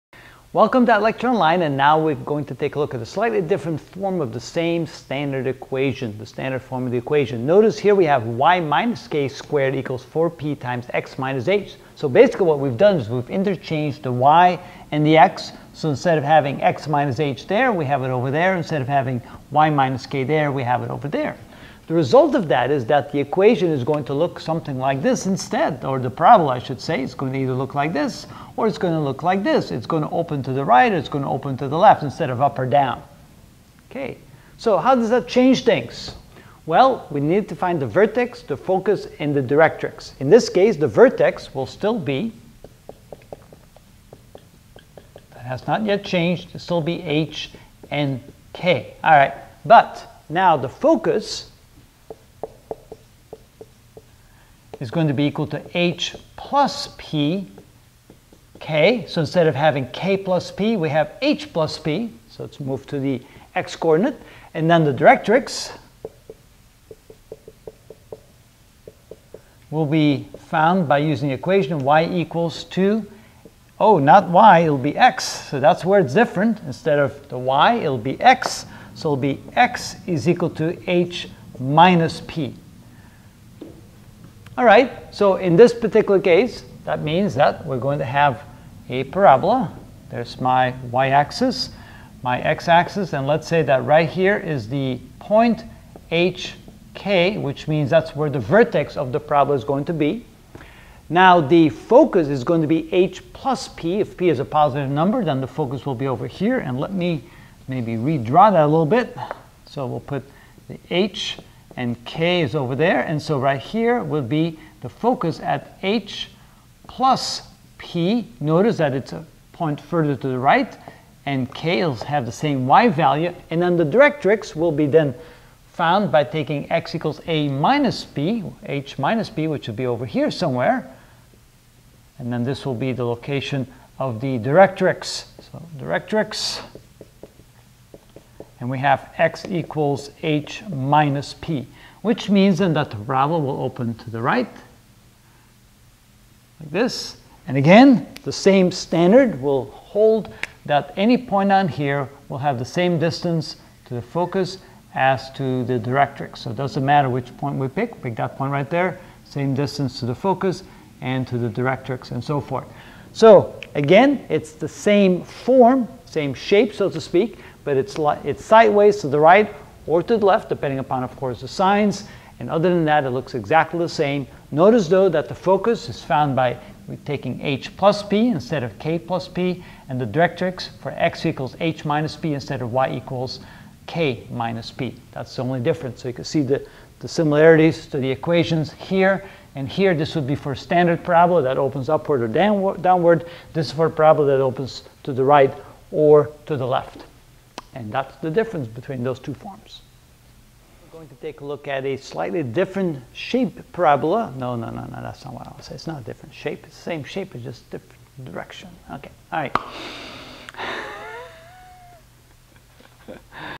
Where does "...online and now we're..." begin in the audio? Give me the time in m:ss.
0:01.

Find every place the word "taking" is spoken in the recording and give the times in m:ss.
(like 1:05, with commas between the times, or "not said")
2:06, 2:57.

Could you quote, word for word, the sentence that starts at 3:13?
This is for parabola that opens to the right or to the left.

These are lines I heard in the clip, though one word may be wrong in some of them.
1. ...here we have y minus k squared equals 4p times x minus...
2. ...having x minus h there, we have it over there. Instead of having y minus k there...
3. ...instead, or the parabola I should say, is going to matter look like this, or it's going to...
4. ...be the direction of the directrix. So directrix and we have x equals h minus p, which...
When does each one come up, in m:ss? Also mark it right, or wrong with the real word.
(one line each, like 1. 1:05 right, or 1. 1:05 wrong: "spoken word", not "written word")
1. 0:07 right
2. 0:16 right
3. 0:25 wrong: "either", not "matter"
4. 2:12 wrong: "location", not "direction".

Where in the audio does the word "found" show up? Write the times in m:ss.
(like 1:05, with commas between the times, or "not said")
1:10, 2:05, 2:56.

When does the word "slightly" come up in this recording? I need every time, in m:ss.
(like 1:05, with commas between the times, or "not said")
0:03, 3:21.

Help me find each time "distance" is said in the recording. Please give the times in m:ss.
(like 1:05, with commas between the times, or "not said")
2:32, 2:39.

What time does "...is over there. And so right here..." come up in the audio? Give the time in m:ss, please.
1:52.